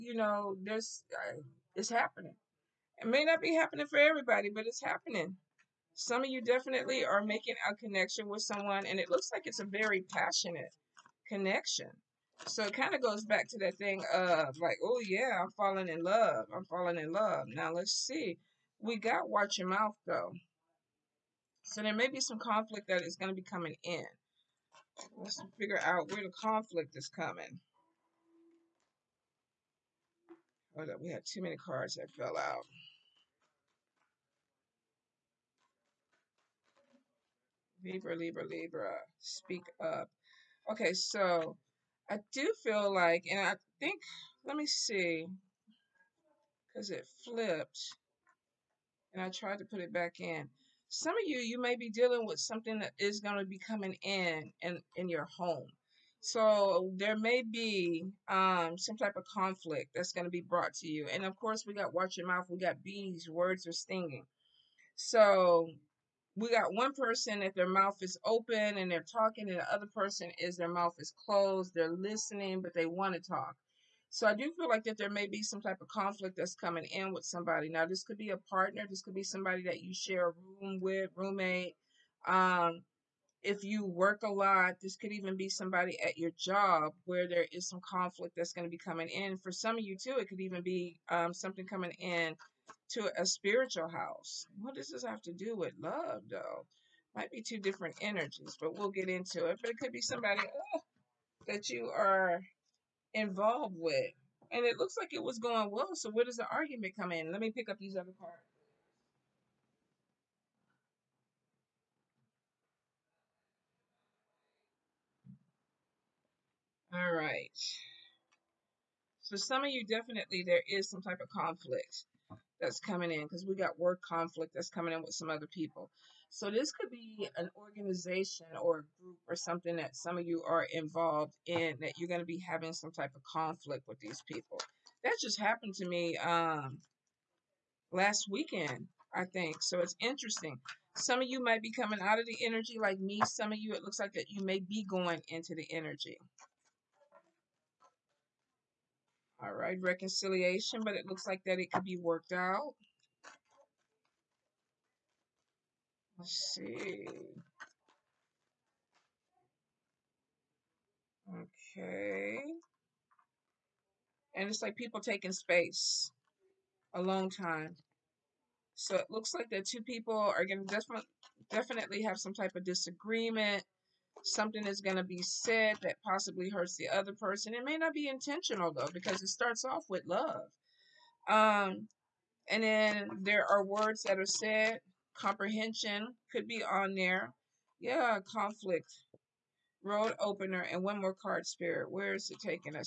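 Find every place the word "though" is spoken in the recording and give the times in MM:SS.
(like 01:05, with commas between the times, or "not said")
00:20, 01:36, 02:58.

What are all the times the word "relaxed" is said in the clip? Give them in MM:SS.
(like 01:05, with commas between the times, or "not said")
not said.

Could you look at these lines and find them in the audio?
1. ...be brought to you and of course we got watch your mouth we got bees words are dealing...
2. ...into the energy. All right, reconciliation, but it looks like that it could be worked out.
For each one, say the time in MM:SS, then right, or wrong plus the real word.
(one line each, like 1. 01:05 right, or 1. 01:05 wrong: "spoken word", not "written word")
1. 01:00 wrong: "stinging", not "dealing"
2. 02:25 right.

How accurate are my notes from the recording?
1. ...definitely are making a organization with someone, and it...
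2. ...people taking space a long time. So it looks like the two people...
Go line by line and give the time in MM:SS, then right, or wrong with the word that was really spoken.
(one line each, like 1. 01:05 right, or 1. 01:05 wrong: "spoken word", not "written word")
1. 00:06 wrong: "connection", not "organization"
2. 02:44 right.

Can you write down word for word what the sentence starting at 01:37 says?
Might be two different energies, but we'll get into it.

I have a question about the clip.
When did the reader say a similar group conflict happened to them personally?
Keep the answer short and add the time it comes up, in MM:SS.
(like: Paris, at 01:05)
last weekend, at 02:17.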